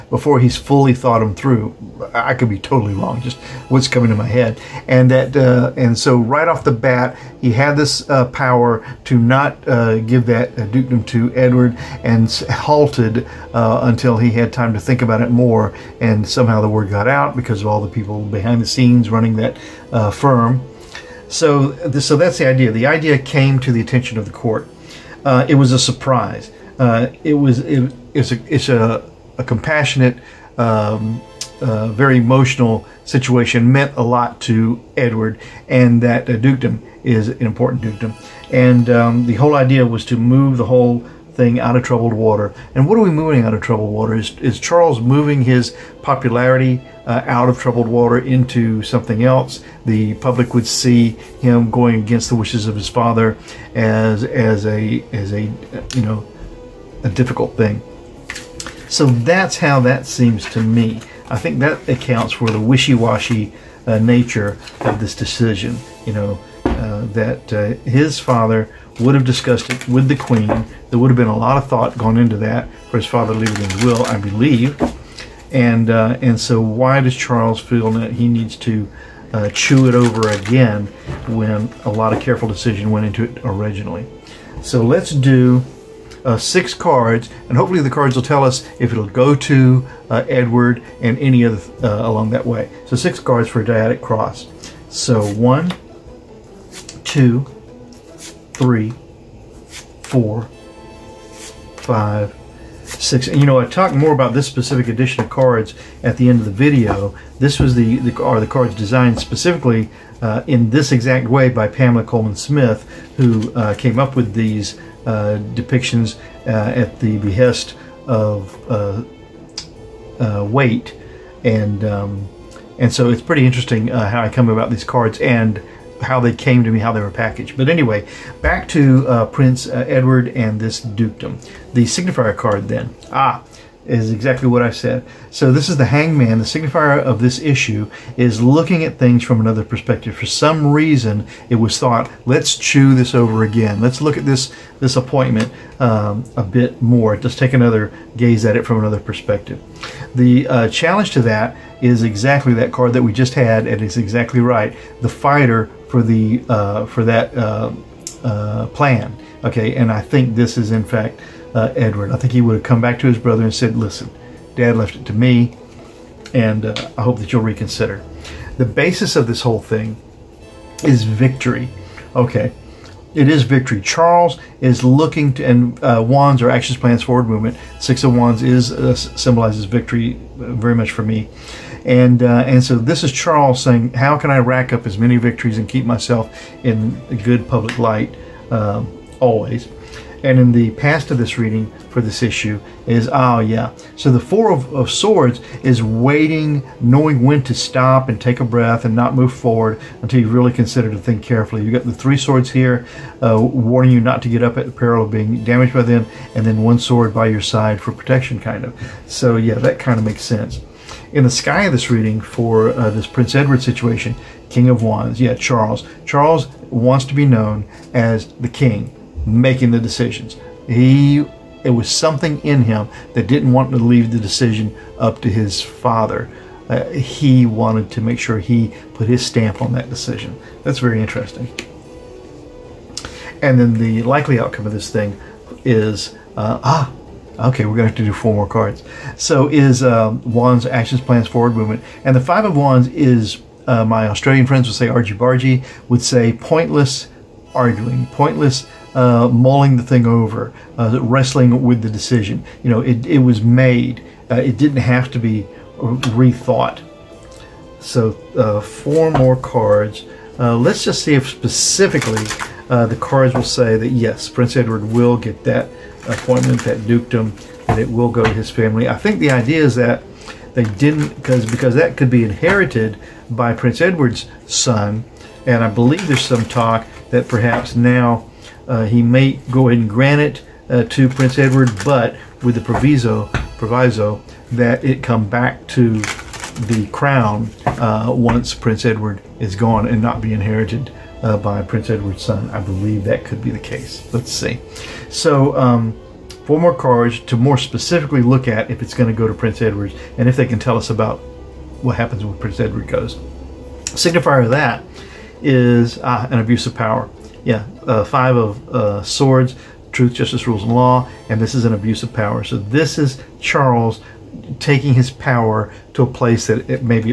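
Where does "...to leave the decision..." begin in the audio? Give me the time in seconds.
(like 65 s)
223 s.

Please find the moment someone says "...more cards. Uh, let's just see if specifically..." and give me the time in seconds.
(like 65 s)
259 s.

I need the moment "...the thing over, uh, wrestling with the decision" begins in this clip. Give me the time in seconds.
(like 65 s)
249 s.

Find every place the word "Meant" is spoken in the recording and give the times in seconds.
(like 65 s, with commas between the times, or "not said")
33 s.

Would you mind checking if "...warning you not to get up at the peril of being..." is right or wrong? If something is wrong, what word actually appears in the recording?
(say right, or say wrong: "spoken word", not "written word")
right.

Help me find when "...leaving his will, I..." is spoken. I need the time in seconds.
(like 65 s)
73 s.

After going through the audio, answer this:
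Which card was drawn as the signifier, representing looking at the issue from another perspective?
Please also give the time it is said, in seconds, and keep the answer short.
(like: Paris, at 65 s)
The hangman, at 135 s.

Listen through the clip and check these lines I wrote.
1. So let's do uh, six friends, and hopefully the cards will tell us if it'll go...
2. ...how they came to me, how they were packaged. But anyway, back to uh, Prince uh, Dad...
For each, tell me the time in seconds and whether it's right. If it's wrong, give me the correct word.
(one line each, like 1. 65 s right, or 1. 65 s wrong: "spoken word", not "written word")
1. 84 s wrong: "cards", not "friends"
2. 126 s wrong: "Edward", not "Dad".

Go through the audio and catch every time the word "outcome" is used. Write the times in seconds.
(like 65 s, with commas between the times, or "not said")
234 s.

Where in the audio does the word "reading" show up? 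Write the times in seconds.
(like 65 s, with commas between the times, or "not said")
191 s, 211 s.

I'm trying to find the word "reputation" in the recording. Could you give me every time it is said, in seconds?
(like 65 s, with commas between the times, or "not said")
not said.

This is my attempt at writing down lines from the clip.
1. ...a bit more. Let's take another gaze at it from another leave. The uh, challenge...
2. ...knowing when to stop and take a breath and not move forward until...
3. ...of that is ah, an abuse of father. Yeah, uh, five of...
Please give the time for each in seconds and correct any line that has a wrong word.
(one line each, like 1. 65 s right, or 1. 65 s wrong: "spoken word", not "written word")
1. 146 s wrong: "perspective", not "leave"
2. 196 s right
3. 304 s wrong: "power", not "father".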